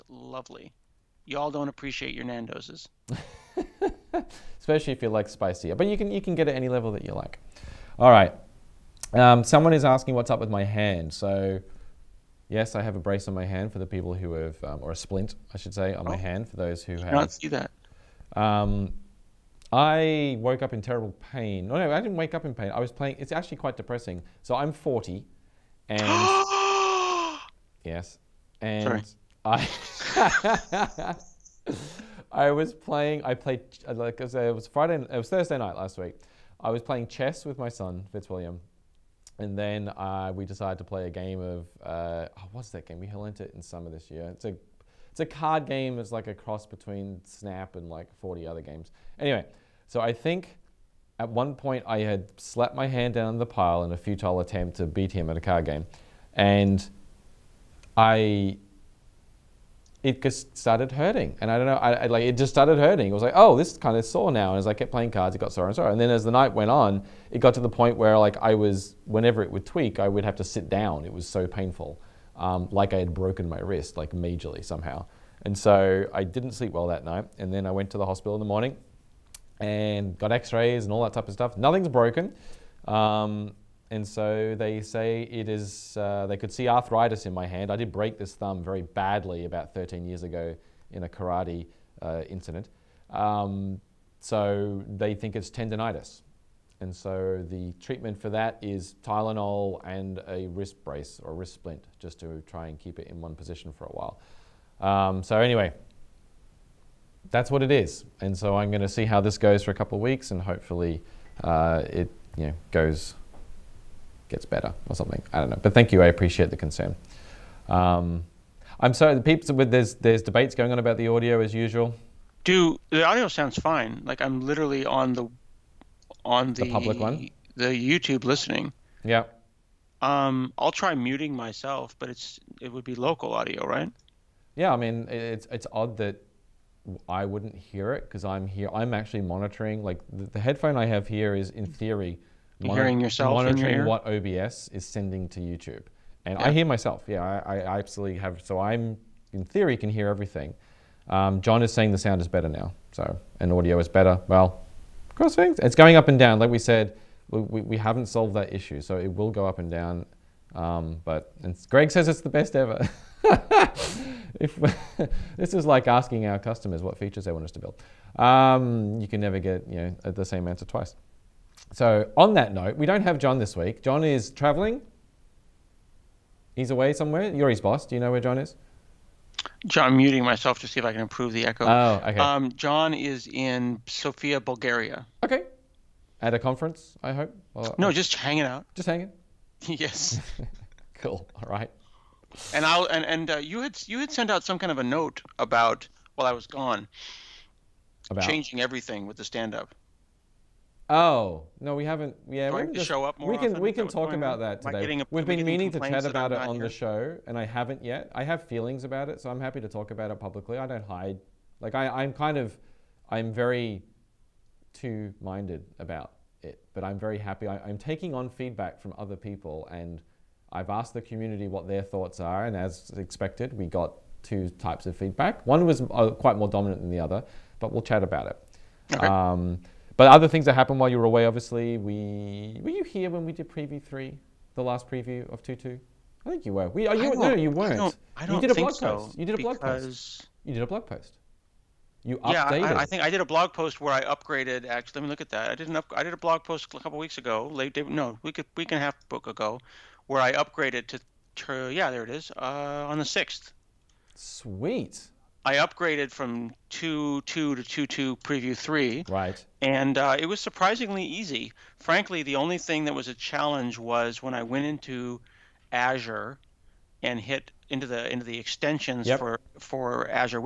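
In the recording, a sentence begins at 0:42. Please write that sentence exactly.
We learned it in summer this year.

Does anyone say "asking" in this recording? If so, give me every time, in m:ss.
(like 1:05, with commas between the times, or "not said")
0:09, 2:45.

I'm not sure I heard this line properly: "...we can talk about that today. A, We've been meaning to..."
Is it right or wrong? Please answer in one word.
right.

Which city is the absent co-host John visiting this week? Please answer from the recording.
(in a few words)
Sofia.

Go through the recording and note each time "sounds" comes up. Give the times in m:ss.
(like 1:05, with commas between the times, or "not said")
2:03, 2:31.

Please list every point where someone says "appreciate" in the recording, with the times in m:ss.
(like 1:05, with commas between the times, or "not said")
0:01, 1:56.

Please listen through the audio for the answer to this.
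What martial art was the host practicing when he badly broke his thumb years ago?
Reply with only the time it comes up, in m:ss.
1:31.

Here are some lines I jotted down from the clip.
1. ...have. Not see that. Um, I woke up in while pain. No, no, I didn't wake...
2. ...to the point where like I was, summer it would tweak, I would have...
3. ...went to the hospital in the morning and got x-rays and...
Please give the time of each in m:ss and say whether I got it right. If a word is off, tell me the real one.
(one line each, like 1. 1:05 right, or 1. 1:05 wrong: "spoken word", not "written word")
1. 0:16 wrong: "terrible", not "while"
2. 1:07 wrong: "whenever", not "summer"
3. 1:17 right.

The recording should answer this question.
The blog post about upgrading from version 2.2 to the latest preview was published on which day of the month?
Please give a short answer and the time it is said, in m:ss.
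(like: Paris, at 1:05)
6th, at 4:13.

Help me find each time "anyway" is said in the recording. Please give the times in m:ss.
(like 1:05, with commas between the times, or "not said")
0:49, 1:45.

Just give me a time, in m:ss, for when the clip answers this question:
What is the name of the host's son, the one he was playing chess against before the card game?
0:38.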